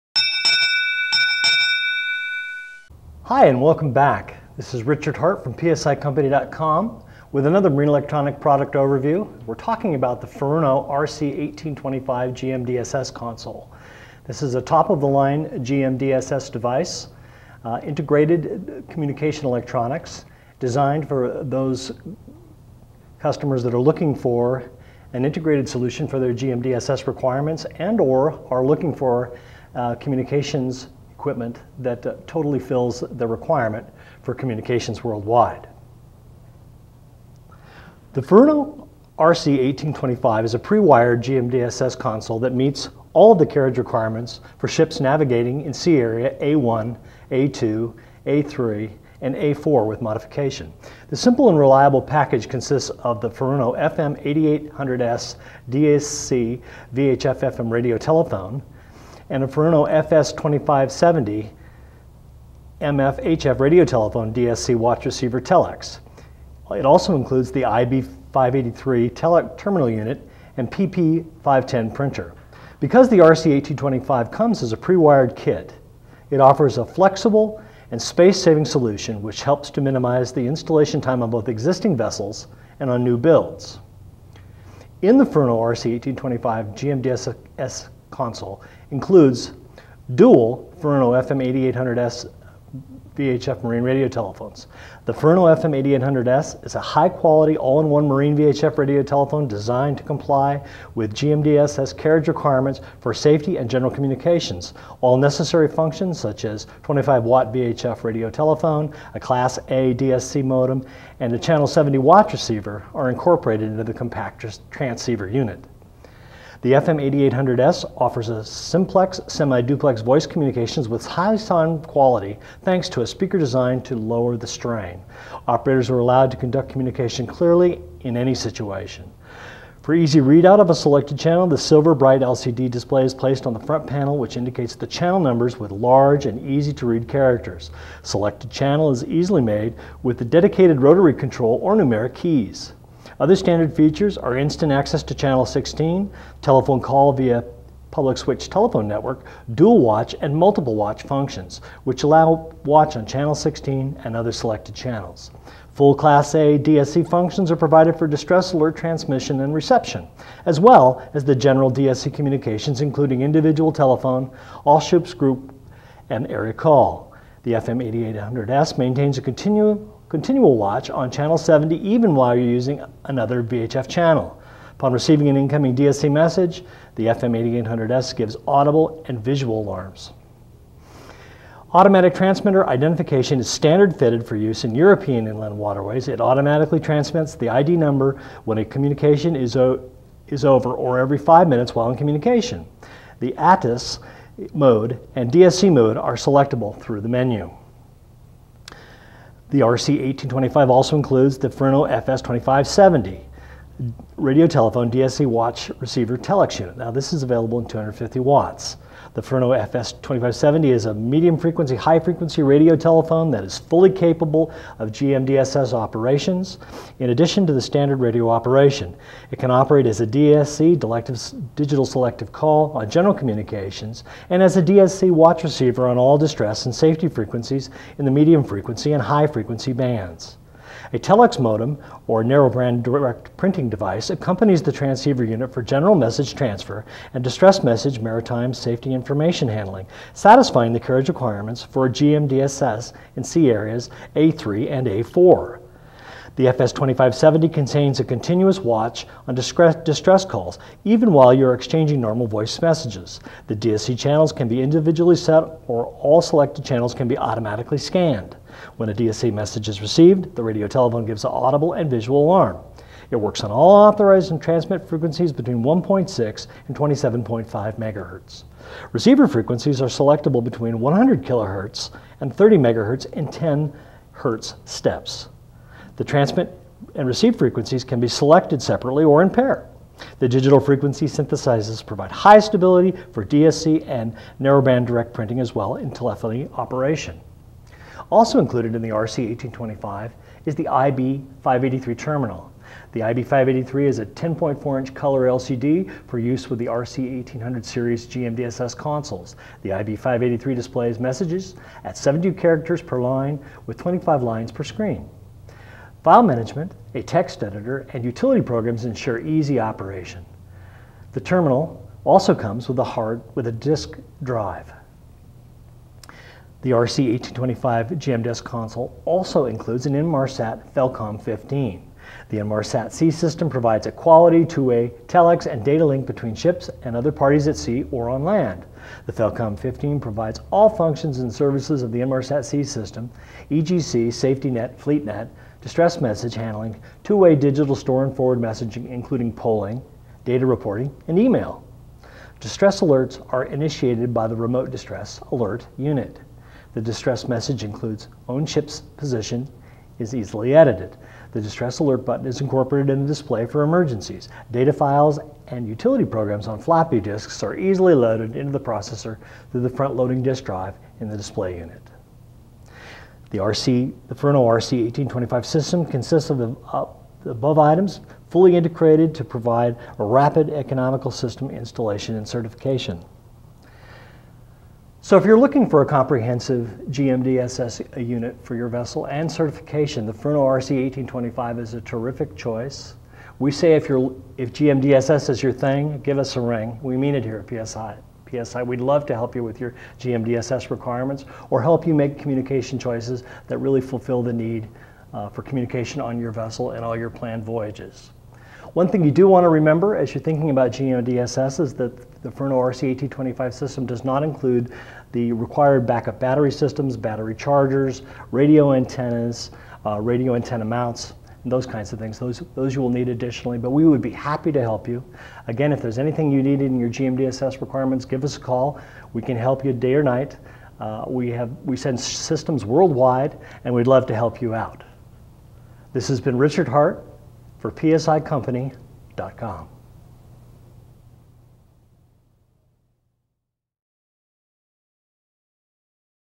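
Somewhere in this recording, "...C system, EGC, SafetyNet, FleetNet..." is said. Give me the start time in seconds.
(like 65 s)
332 s.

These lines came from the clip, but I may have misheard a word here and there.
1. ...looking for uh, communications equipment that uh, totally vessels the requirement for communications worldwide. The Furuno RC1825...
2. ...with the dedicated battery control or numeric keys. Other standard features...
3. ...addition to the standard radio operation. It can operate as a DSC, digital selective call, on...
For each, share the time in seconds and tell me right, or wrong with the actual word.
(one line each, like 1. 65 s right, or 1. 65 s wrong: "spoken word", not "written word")
1. 28 s wrong: "fills", not "vessels"
2. 140 s wrong: "rotary", not "battery"
3. 217 s right.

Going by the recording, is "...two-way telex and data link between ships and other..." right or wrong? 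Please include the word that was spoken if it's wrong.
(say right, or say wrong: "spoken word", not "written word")
right.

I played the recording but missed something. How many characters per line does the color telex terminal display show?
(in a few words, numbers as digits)
72.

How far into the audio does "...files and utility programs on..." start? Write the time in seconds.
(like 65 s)
354 s.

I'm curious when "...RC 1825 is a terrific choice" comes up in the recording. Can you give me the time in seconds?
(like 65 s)
380 s.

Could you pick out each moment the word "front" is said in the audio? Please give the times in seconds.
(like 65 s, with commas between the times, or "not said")
133 s, 359 s.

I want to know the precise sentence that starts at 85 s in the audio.
In the Furuno RC1825 GMDSS console includes dual Furuno FM 8800S VHF marine radio telephones.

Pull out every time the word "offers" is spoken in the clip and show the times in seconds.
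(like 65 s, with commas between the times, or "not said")
76 s, 117 s.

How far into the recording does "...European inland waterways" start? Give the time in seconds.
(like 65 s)
184 s.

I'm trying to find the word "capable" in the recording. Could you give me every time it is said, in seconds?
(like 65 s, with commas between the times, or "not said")
213 s.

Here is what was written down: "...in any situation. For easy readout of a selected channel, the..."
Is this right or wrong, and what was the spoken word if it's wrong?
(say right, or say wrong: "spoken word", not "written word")
right.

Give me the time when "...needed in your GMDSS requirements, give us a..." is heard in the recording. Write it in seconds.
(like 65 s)
416 s.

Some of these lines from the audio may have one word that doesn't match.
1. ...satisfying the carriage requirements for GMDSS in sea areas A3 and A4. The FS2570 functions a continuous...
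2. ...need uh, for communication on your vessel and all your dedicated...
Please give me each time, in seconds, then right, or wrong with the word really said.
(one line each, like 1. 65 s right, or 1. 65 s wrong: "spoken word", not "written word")
1. 240 s wrong: "contains", not "functions"
2. 394 s wrong: "planned", not "dedicated".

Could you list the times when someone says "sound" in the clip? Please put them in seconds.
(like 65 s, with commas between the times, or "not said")
121 s.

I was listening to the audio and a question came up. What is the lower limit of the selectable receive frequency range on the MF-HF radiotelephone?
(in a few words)
100 kilohertz.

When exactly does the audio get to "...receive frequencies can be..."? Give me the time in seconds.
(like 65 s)
277 s.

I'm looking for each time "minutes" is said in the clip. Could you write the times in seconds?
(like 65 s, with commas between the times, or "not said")
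191 s.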